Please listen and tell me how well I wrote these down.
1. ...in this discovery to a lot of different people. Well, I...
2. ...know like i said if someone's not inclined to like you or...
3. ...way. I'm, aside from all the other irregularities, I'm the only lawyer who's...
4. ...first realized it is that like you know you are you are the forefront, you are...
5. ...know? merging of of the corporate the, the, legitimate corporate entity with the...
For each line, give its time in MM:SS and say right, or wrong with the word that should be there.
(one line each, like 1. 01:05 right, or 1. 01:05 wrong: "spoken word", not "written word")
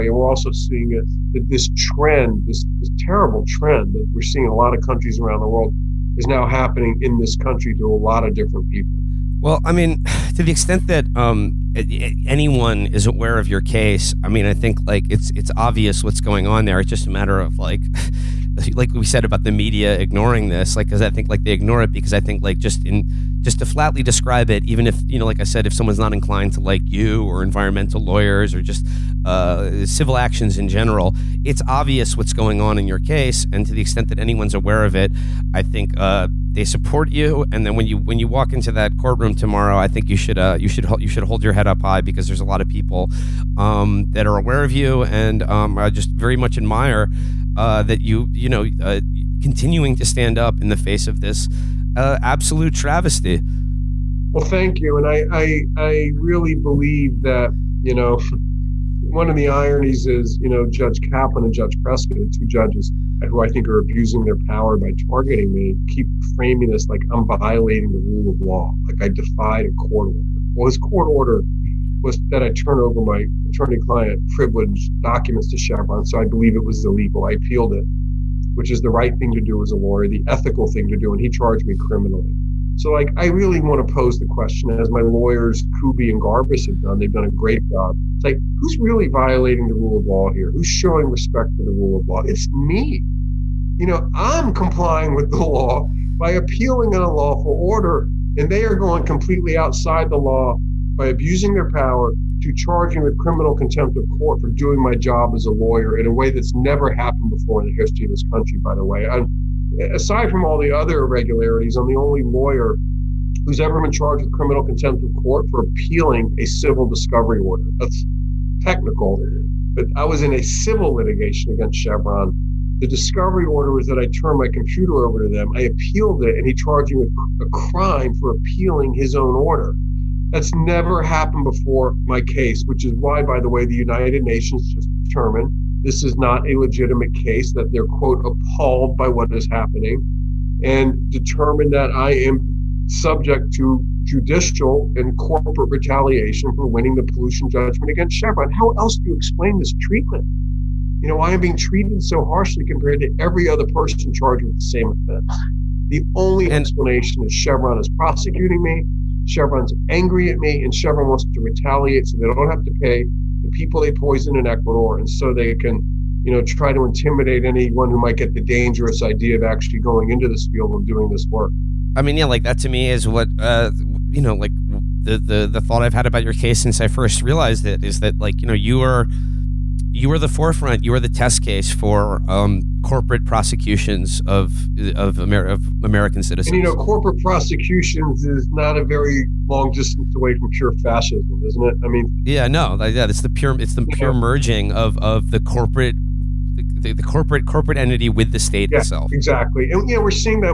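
1. 00:07 wrong: "country", not "discovery"
2. 00:25 right
3. 01:48 right
4. 02:56 right
5. 03:14 wrong: "corporate", not "legitimate".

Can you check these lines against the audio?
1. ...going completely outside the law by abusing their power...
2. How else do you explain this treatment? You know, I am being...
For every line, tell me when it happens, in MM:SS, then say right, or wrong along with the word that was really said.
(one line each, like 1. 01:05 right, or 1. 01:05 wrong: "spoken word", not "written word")
1. 01:38 right
2. 02:28 right.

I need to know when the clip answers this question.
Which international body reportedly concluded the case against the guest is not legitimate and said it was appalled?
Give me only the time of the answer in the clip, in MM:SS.
02:13.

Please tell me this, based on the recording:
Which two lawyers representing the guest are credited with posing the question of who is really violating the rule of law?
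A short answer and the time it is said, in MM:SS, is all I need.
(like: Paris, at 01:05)
Kuby and Garbus, at 01:25.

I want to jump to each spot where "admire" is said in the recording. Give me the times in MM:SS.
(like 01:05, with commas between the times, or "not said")
00:46.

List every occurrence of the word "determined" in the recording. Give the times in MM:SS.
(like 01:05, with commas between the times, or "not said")
02:15, 02:21.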